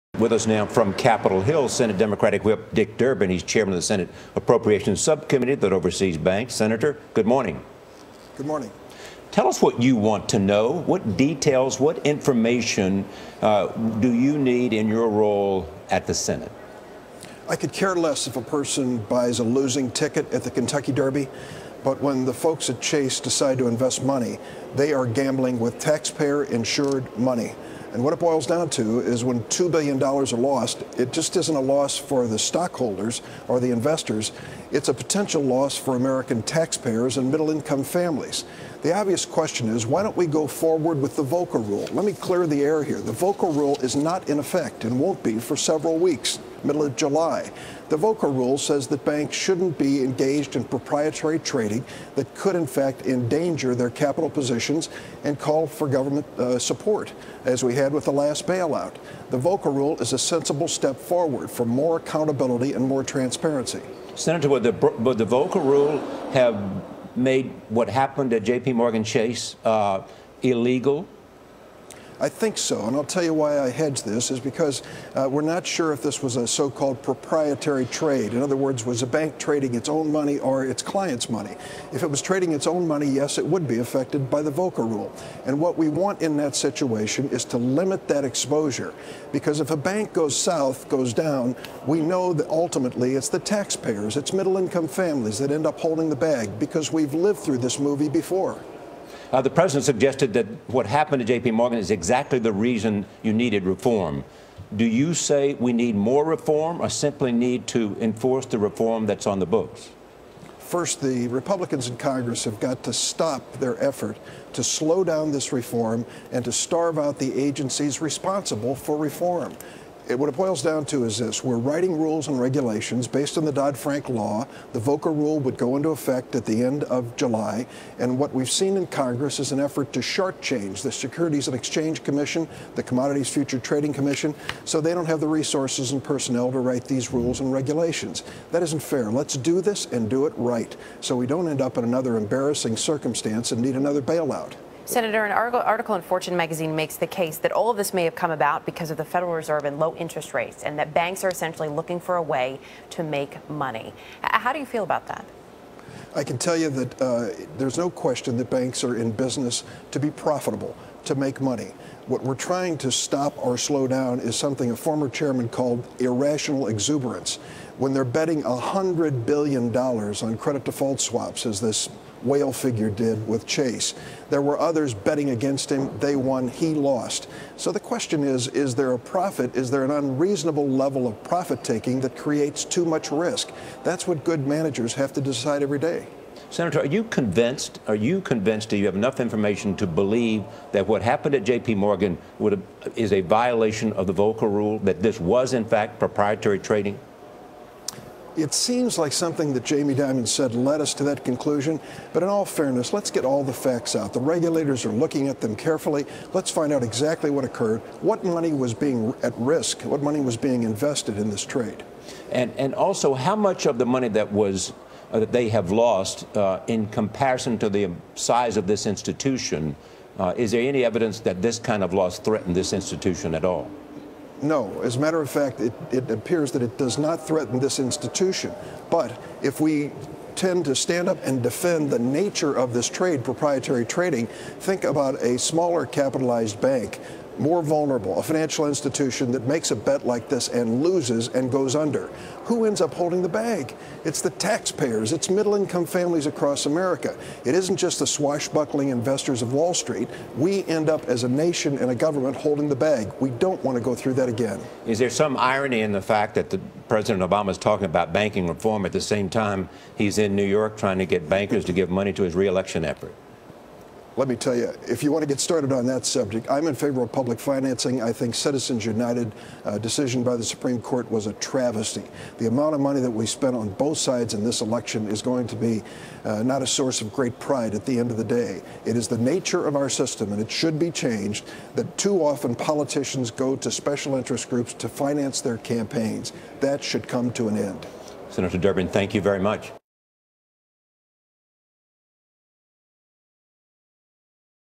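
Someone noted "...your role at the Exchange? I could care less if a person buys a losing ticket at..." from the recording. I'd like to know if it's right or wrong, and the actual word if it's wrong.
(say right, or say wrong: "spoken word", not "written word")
wrong: "Senate", not "Exchange".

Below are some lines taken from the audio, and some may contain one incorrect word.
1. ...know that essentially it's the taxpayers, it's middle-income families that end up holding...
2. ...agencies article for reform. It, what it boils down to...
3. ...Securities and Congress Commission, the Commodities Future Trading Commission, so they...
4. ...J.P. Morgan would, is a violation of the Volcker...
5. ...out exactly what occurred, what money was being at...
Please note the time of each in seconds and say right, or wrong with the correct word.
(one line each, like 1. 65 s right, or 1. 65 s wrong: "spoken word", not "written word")
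1. 92 s wrong: "ultimately", not "essentially"
2. 117 s wrong: "responsible", not "article"
3. 130 s wrong: "Exchange", not "Congress"
4. 191 s right
5. 206 s right.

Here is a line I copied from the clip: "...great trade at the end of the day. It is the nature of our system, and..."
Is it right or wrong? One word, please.
wrong.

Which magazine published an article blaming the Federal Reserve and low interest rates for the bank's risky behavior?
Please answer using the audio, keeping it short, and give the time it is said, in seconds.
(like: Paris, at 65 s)
Fortune, at 146 s.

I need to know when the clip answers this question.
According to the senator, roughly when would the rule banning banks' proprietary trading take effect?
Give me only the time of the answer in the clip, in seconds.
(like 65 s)
46 s.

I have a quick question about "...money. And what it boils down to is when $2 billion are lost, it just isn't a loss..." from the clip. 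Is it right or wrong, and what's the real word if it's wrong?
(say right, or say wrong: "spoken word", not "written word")
right.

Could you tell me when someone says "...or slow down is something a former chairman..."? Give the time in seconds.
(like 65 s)
163 s.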